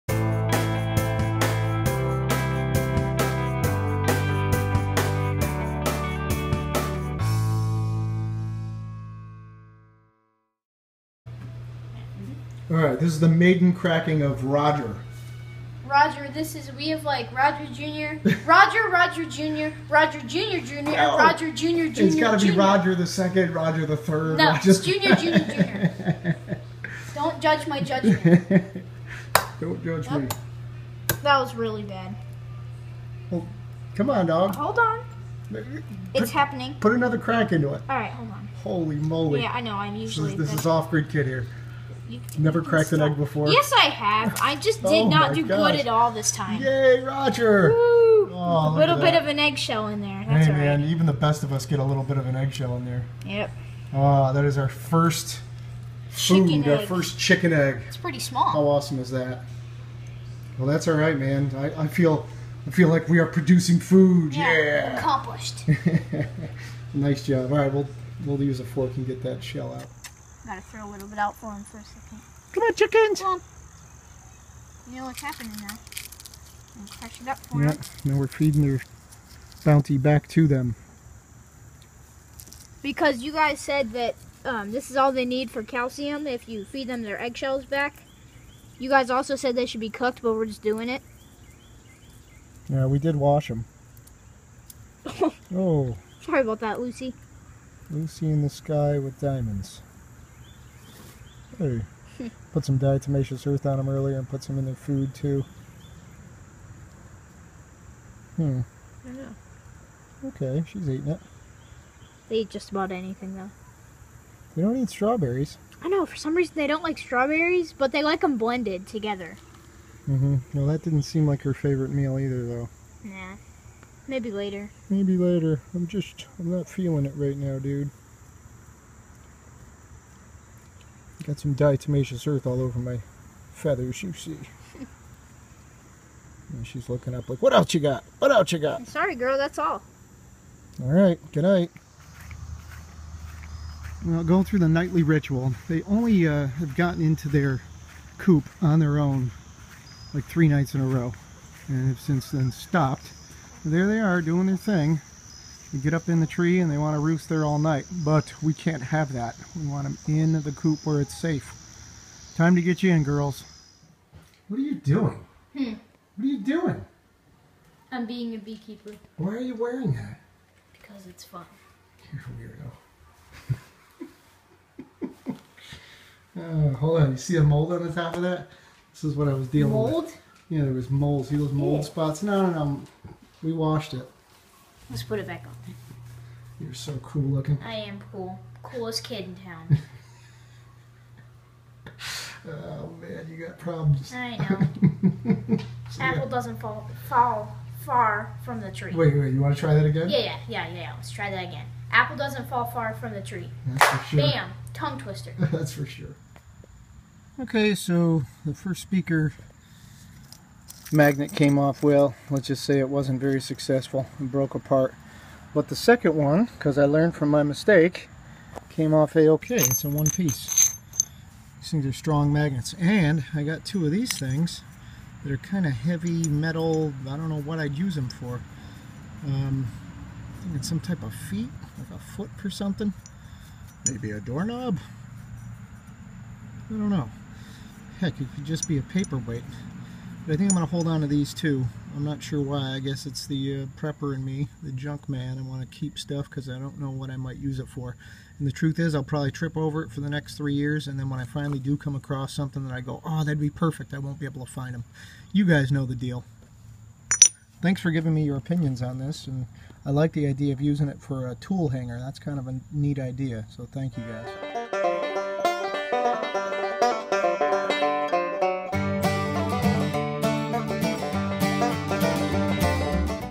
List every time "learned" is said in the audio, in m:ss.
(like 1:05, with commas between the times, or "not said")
3:36.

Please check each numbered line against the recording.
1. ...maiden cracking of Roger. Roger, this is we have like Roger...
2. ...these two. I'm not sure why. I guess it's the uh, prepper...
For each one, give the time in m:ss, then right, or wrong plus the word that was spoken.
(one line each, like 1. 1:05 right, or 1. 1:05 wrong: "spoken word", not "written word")
1. 0:13 right
2. 4:01 right.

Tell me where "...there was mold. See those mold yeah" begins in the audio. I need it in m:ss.
3:00.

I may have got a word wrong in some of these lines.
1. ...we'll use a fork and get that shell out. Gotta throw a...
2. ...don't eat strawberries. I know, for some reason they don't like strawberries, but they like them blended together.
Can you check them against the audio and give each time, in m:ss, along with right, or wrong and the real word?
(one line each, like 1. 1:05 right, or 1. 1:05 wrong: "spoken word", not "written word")
1. 1:08 right
2. 1:54 right.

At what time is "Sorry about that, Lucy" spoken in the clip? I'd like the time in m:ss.
1:36.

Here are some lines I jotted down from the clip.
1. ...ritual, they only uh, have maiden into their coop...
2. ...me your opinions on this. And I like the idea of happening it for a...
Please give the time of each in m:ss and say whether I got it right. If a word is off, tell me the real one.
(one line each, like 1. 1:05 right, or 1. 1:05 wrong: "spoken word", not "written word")
1. 2:25 wrong: "gotten", not "maiden"
2. 4:18 wrong: "using", not "happening".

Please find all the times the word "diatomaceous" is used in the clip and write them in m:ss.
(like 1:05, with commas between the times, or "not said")
1:42, 2:11.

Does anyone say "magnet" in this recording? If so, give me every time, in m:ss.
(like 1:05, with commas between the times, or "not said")
3:30, 3:42.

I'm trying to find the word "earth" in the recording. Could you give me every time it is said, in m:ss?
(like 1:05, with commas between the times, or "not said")
1:43, 2:12.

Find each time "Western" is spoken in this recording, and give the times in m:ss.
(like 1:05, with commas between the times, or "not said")
not said.